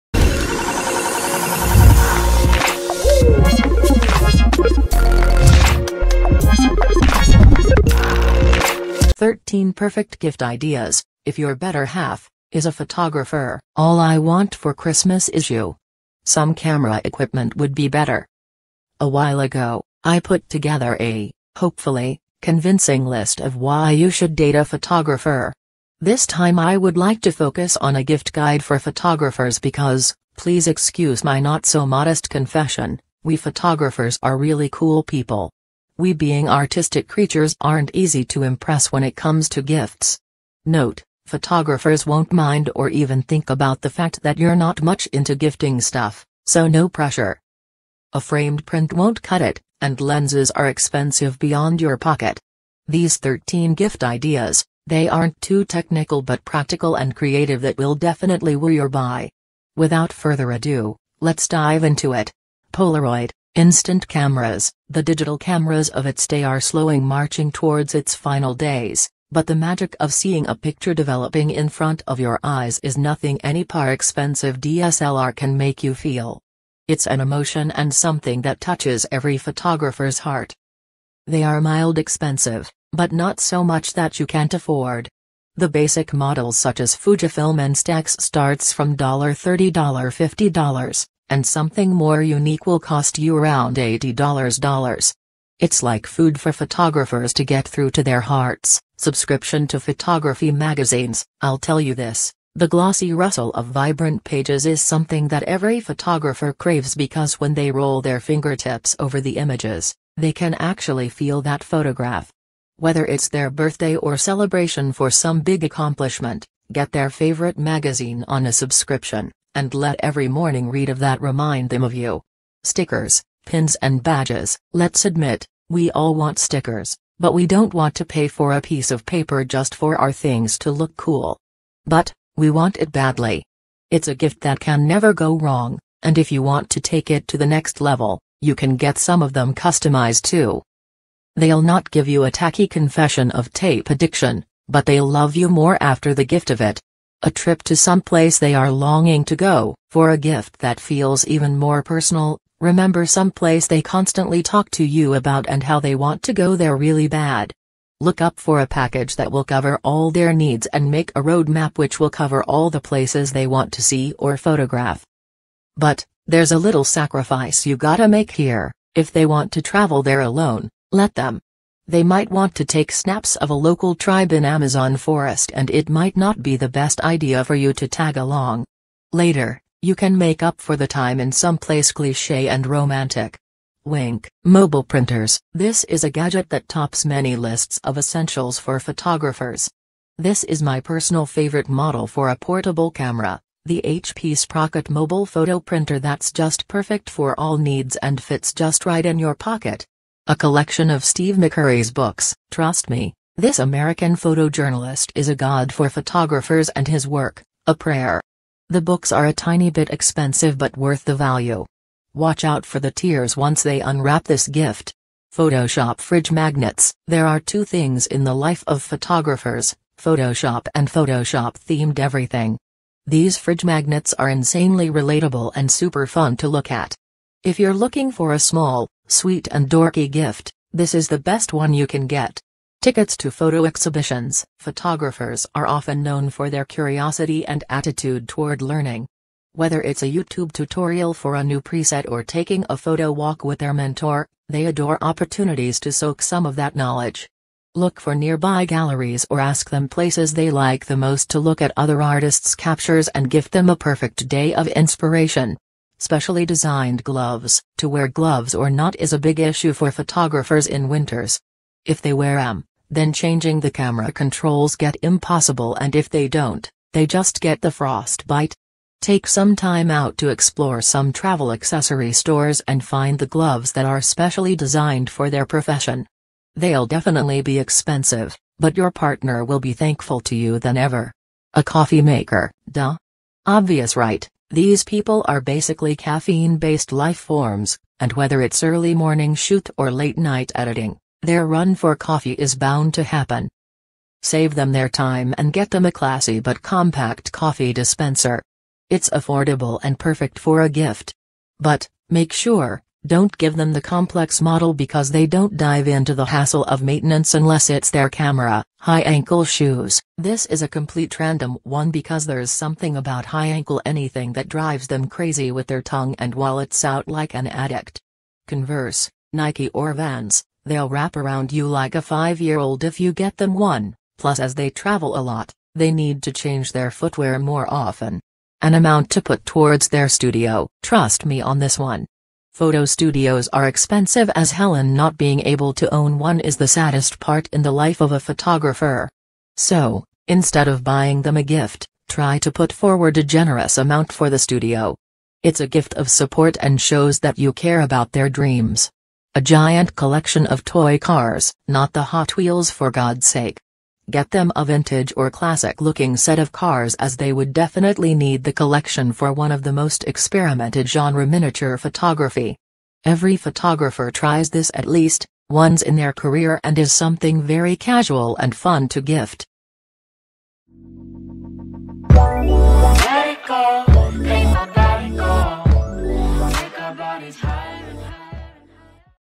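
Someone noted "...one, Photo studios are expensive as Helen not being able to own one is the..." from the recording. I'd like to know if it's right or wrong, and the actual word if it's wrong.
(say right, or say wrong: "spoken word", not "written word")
right.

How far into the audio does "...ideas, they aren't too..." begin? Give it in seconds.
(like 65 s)
54 s.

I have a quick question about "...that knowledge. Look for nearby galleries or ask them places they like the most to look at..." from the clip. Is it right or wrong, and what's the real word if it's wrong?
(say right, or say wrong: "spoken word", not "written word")
right.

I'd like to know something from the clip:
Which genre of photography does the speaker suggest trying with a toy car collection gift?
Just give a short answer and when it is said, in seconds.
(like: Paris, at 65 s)
miniature photography, at 361 s.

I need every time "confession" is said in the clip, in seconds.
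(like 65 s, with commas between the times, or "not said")
32 s, 142 s.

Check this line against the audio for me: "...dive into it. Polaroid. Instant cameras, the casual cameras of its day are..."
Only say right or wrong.
wrong.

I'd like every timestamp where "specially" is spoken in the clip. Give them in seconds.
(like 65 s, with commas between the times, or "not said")
256 s, 274 s.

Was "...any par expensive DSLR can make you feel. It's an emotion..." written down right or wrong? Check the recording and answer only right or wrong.
right.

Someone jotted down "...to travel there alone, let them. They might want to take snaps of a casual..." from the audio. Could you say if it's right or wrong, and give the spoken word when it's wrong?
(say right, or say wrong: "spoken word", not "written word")
wrong: "local", not "casual".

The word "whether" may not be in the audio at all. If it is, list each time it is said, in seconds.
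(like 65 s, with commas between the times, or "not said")
112 s, 239 s, 288 s.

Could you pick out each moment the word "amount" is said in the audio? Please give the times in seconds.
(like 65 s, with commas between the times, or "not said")
328 s, 343 s.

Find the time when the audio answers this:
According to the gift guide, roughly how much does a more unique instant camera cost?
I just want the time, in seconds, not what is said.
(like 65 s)
93 s.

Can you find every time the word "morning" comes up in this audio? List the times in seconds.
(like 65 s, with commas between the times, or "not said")
120 s, 288 s.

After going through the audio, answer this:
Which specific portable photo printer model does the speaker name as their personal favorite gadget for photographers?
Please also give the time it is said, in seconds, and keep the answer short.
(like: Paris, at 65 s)
HP Sprocket, at 193 s.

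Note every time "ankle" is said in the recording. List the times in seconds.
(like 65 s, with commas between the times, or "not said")
309 s, 313 s.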